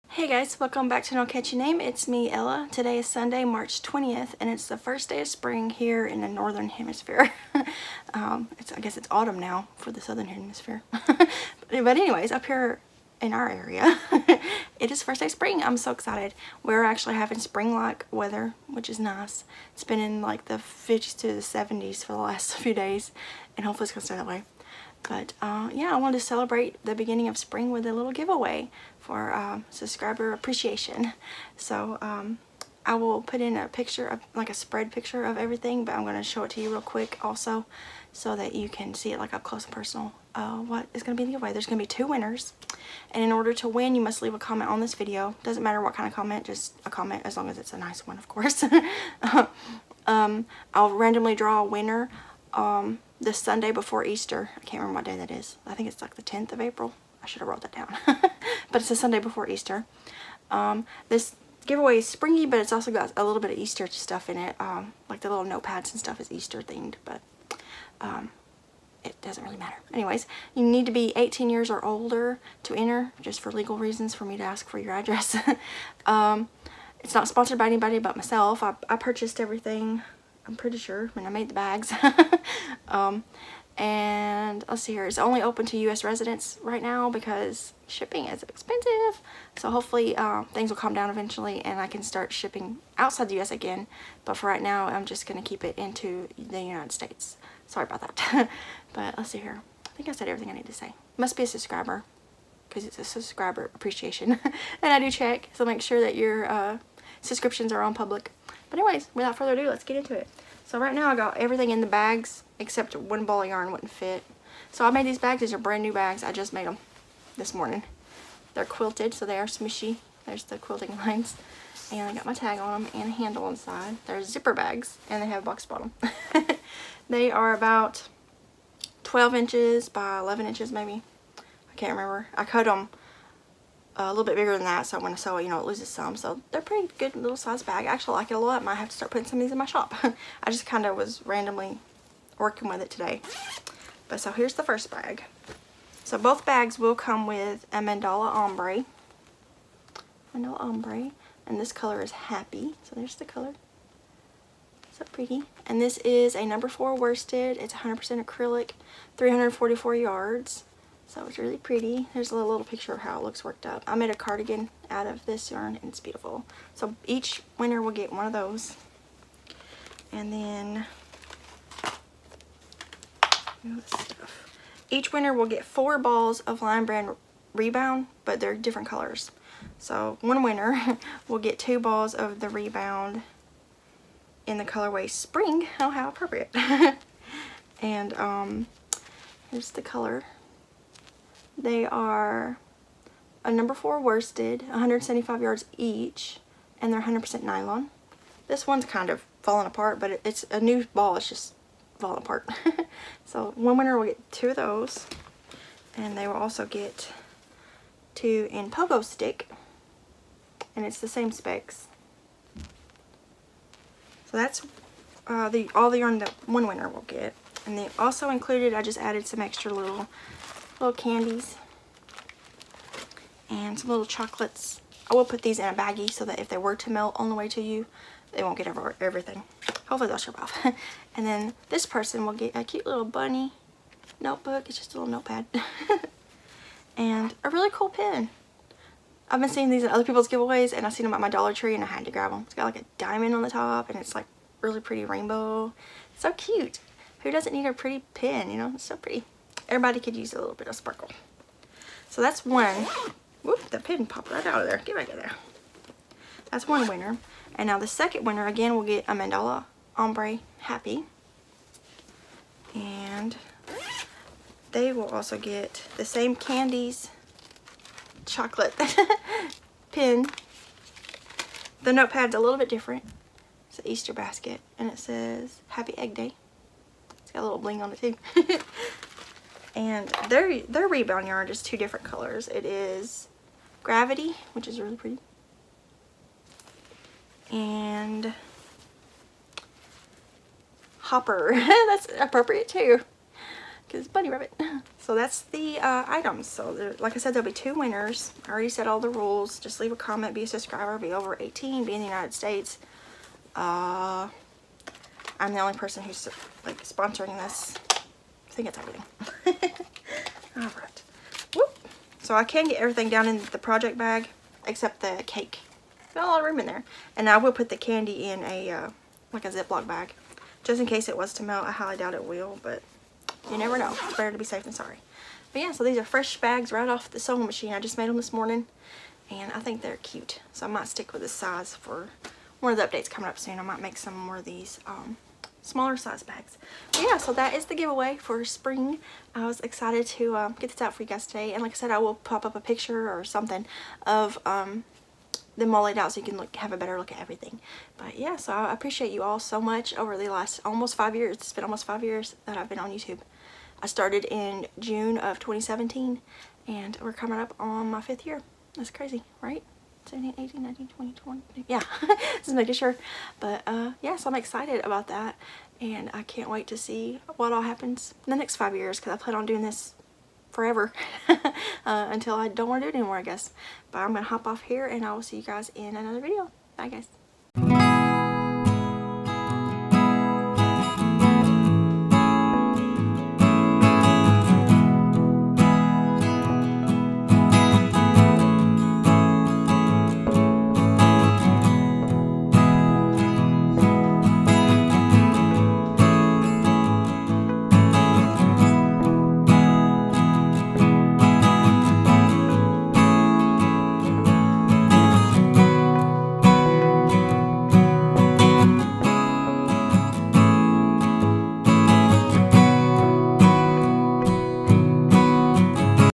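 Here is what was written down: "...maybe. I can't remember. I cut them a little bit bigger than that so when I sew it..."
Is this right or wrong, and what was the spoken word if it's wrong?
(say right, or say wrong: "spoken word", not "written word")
right.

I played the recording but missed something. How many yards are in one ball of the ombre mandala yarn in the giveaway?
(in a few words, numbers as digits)
344.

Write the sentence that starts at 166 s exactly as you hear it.
So each winner will get one of those.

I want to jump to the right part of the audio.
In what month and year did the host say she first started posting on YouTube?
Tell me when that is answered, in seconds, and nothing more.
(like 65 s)
354 s.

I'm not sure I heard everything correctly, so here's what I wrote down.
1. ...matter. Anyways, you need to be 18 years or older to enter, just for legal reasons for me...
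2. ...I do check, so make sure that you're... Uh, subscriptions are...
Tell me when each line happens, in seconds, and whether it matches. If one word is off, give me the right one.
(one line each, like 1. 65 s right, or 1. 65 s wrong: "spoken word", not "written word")
1. 69 s right
2. 104 s right.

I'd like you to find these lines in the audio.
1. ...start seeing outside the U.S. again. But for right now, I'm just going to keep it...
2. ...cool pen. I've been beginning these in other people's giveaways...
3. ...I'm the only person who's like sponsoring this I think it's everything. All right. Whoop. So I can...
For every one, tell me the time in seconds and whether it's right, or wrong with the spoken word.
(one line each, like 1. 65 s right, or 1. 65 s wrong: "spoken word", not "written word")
1. 92 s wrong: "shipping", not "seeing"
2. 237 s wrong: "seeing", not "beginning"
3. 305 s right.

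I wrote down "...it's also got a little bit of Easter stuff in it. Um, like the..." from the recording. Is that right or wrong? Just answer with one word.
right.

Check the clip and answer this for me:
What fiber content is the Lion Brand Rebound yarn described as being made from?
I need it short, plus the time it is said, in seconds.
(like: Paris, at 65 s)
100% nylon, at 197 s.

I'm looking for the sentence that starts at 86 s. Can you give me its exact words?
residents right now because shipping is expensive.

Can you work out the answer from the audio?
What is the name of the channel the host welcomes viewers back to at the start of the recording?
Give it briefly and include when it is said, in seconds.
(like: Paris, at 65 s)
No Catchy Name, at 1 s.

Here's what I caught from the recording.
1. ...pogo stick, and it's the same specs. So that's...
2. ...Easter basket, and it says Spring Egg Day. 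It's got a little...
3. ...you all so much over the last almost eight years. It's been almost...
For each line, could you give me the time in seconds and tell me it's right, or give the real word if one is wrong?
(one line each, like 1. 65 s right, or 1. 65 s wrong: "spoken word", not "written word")
1. 208 s right
2. 273 s wrong: "Happy", not "Spring"
3. 349 s wrong: "five", not "eight".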